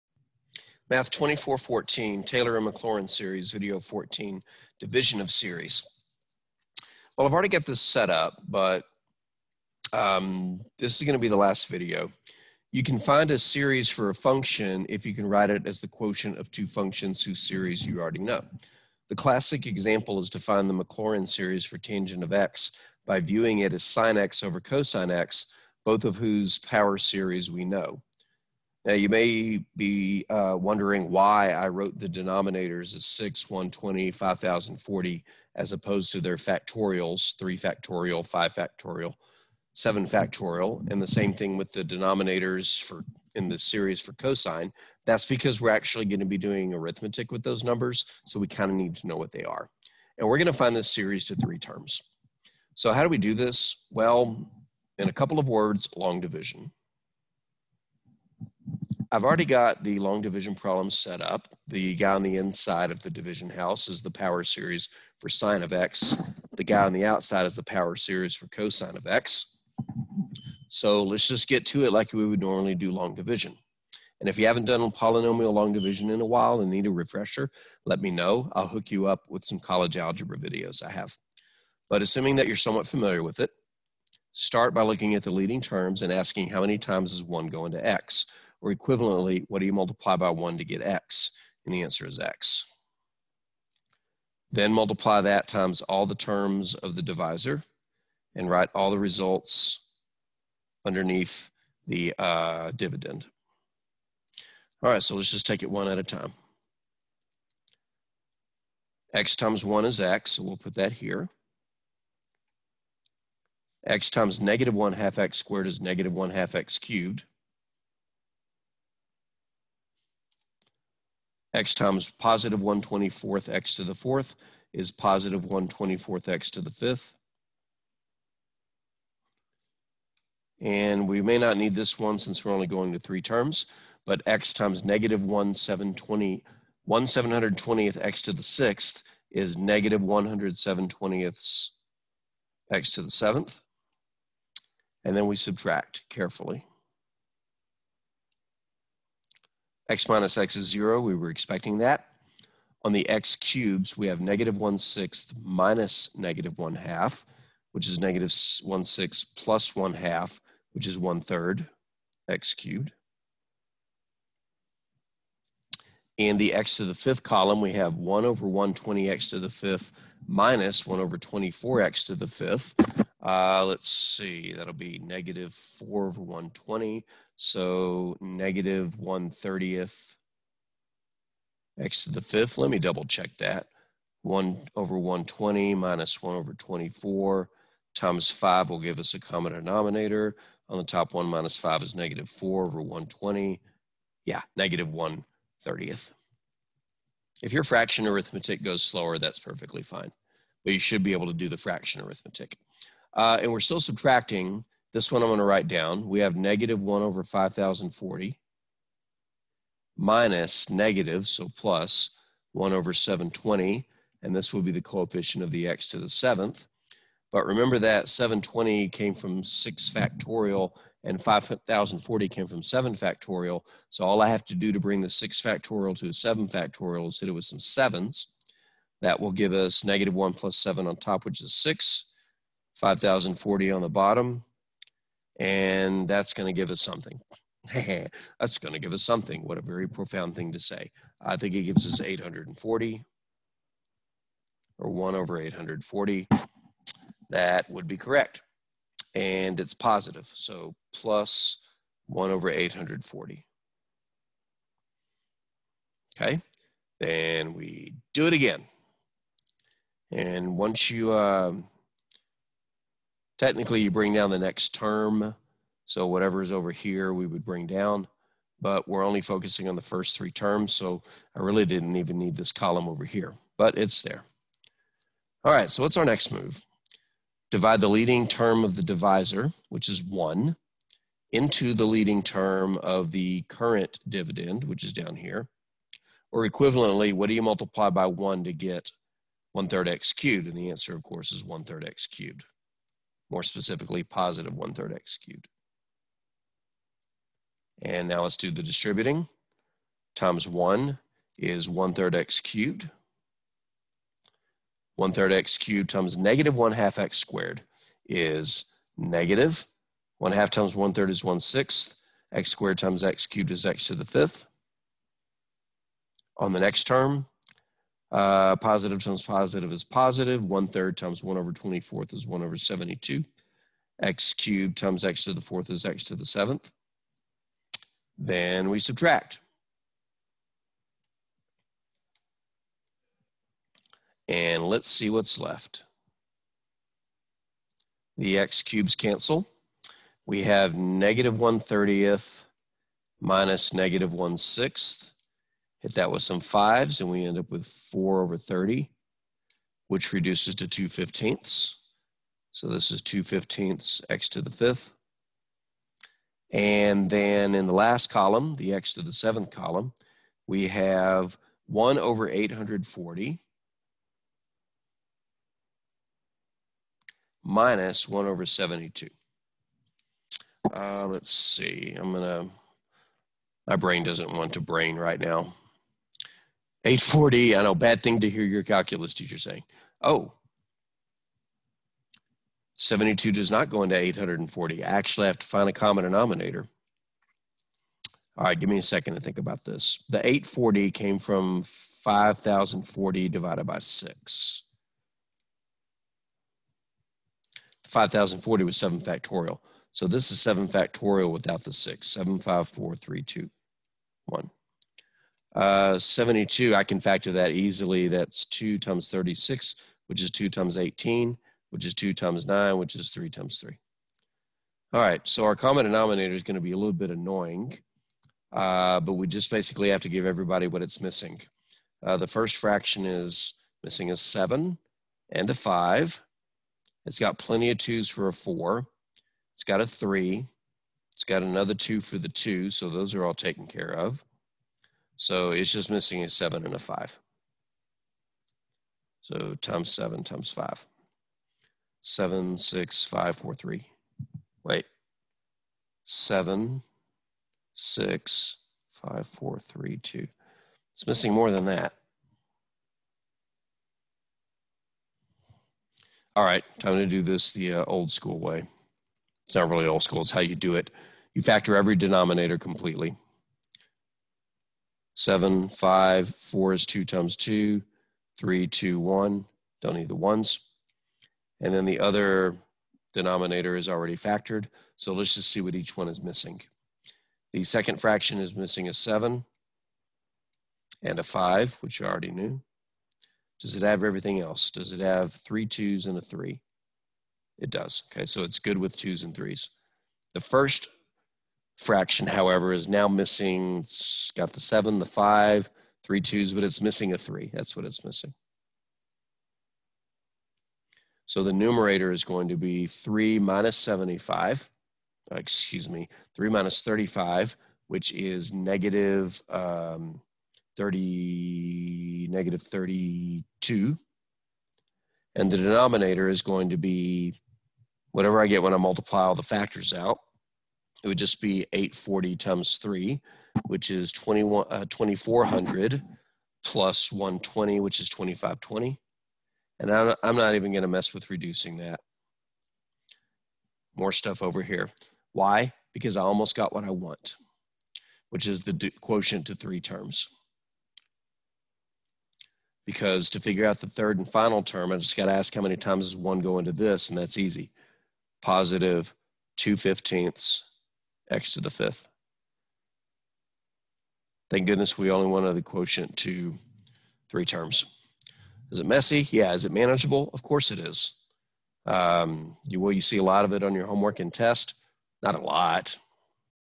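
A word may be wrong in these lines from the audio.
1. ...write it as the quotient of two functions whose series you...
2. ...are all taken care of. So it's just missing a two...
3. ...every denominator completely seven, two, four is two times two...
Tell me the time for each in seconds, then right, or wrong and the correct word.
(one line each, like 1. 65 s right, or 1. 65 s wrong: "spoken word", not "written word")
1. 15 s right
2. 433 s wrong: "seven", not "two"
3. 461 s wrong: "five", not "two".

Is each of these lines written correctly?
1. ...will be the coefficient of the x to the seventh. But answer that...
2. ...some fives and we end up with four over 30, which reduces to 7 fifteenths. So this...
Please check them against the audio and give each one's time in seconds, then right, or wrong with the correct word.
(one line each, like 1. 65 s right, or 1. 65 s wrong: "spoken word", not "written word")
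1. 214 s wrong: "remember", not "answer"
2. 346 s wrong: "2", not "7".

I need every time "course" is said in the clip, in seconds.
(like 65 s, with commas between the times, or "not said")
291 s, 560 s.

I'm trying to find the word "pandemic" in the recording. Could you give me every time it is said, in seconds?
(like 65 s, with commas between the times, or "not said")
not said.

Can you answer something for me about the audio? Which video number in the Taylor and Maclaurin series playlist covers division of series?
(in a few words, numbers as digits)
14.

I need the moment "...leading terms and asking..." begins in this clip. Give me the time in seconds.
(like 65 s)
85 s.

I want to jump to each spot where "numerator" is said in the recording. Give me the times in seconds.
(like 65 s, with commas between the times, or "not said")
501 s.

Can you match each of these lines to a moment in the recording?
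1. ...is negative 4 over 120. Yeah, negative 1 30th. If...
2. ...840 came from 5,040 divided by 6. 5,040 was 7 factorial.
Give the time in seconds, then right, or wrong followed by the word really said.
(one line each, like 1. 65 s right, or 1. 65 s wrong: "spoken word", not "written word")
1. 191 s right
2. 390 s right.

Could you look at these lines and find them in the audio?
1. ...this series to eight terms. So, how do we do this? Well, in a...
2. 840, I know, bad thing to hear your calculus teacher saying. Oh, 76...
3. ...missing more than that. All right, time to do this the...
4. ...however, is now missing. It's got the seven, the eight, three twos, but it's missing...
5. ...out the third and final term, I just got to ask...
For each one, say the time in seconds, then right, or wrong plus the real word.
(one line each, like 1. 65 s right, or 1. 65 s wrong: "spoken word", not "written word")
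1. 50 s wrong: "three", not "eight"
2. 376 s wrong: "72", not "76"
3. 451 s right
4. 492 s wrong: "five", not "eight"
5. 543 s right.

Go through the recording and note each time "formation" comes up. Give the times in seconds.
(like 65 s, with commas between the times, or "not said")
not said.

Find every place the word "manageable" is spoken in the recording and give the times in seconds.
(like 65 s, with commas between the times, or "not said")
559 s.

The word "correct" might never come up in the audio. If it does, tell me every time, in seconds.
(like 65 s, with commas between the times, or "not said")
247 s.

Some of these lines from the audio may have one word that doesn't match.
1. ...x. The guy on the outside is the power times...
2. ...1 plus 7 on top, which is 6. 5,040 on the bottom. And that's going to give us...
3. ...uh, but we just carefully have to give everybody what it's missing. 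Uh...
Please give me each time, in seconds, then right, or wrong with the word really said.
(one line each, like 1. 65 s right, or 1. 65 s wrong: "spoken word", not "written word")
1. 65 s wrong: "series", not "times"
2. 230 s right
3. 418 s wrong: "basically", not "carefully".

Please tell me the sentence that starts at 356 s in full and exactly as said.
And then in the last column, the x to the seventh column, we have 1 over 840 minus 1 over 72.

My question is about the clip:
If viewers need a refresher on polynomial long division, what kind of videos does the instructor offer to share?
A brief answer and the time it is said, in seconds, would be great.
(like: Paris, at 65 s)
college algebra videos, at 79 s.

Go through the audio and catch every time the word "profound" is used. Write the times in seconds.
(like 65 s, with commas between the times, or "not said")
239 s.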